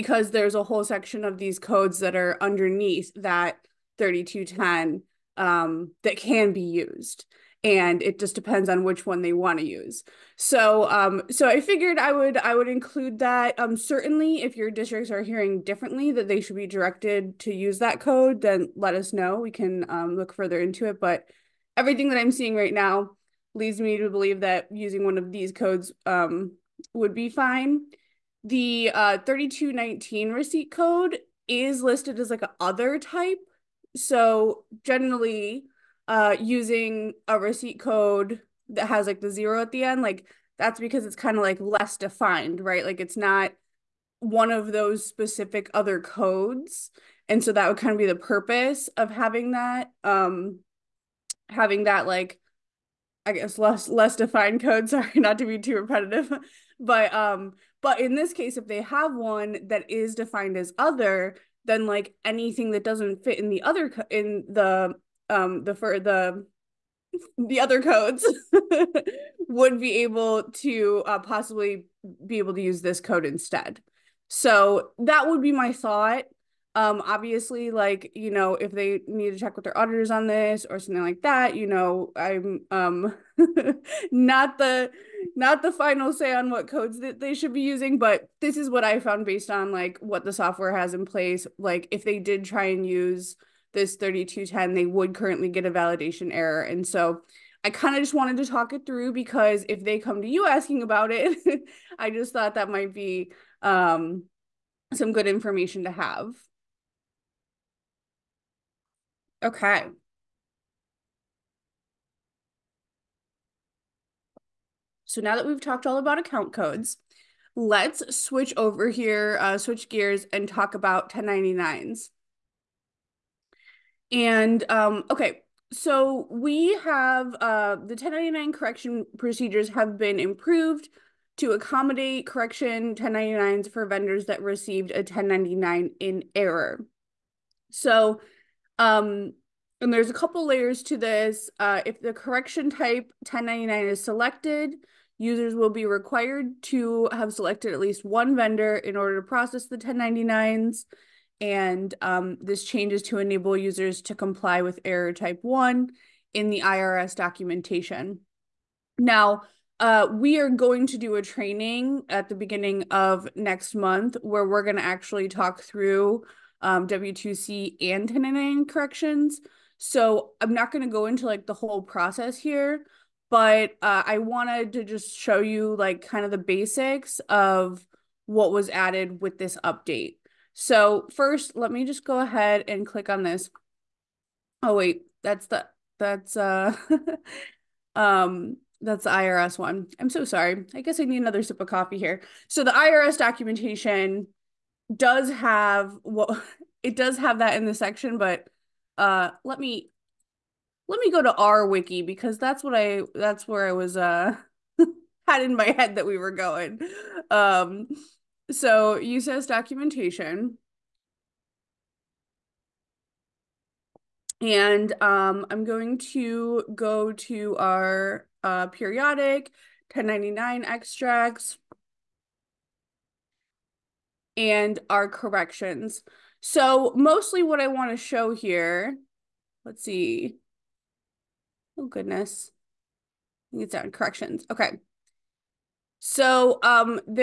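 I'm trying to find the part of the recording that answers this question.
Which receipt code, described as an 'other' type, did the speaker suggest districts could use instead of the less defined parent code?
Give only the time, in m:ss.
0:29.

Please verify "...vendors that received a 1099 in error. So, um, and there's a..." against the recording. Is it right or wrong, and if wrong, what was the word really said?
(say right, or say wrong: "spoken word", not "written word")
right.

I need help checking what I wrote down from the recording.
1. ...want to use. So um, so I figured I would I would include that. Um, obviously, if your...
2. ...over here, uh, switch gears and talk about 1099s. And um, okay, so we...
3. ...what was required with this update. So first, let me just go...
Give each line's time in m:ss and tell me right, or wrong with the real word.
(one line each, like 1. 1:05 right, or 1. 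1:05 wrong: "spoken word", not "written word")
1. 0:09 wrong: "certainly", not "obviously"
2. 1:58 right
3. 2:58 wrong: "added", not "required".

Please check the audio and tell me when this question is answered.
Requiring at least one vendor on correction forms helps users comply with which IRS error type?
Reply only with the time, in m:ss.
2:34.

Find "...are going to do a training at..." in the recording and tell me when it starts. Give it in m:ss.
2:40.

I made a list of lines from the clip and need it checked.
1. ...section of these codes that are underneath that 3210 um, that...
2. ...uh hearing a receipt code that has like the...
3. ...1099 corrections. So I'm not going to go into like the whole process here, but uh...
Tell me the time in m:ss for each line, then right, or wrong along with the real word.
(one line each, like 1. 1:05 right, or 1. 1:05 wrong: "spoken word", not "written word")
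1. 0:00 right
2. 0:36 wrong: "using", not "hearing"
3. 2:48 right.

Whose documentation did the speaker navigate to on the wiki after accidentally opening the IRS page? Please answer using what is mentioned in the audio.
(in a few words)
USAS.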